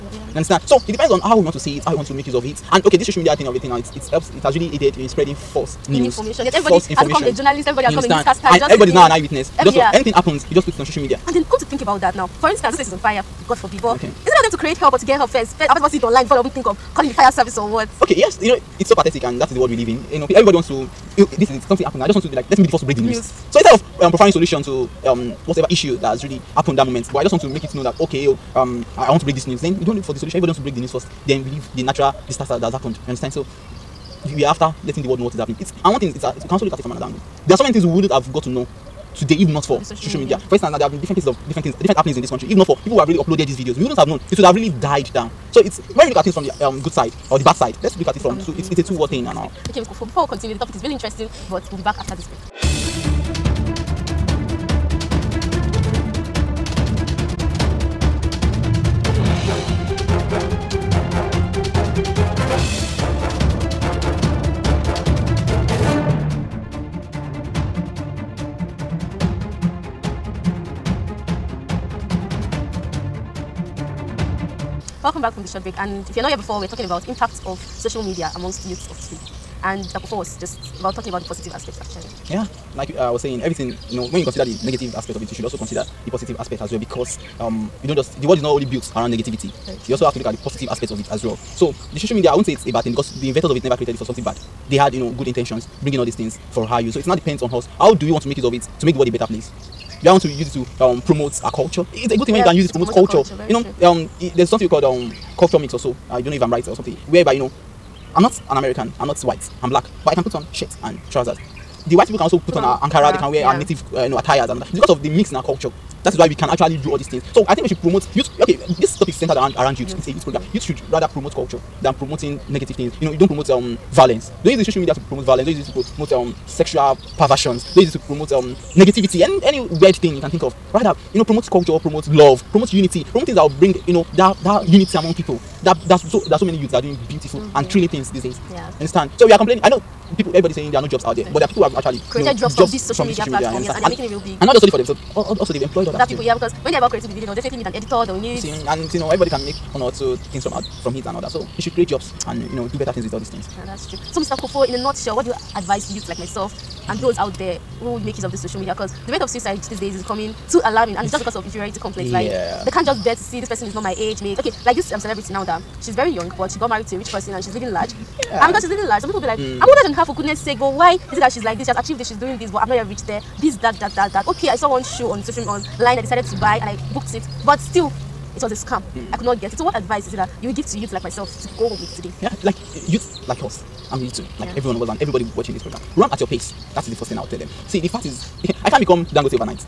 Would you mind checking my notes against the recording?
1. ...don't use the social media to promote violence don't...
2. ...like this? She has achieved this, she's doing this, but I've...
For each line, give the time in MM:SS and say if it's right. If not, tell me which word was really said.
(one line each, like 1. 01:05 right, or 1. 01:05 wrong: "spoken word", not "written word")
1. 02:04 right
2. 02:51 right.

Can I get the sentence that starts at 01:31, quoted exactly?
So the social media, I won't say it's a bad thing because the inventors of it never created it for something bad.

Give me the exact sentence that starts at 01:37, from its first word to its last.
How do we want to make use of it to make the world a better place?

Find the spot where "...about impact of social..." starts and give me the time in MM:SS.
01:16.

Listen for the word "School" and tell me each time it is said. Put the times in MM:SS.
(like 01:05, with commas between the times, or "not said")
00:49.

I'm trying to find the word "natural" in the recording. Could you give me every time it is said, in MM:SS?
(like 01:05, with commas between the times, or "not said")
00:31.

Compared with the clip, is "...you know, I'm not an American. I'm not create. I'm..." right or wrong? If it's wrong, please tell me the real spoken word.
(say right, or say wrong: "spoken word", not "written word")
wrong: "white", not "create".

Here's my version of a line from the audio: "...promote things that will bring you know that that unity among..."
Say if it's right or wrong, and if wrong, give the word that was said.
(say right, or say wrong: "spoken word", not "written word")
right.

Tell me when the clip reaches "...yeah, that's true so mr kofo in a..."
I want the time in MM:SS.
02:33.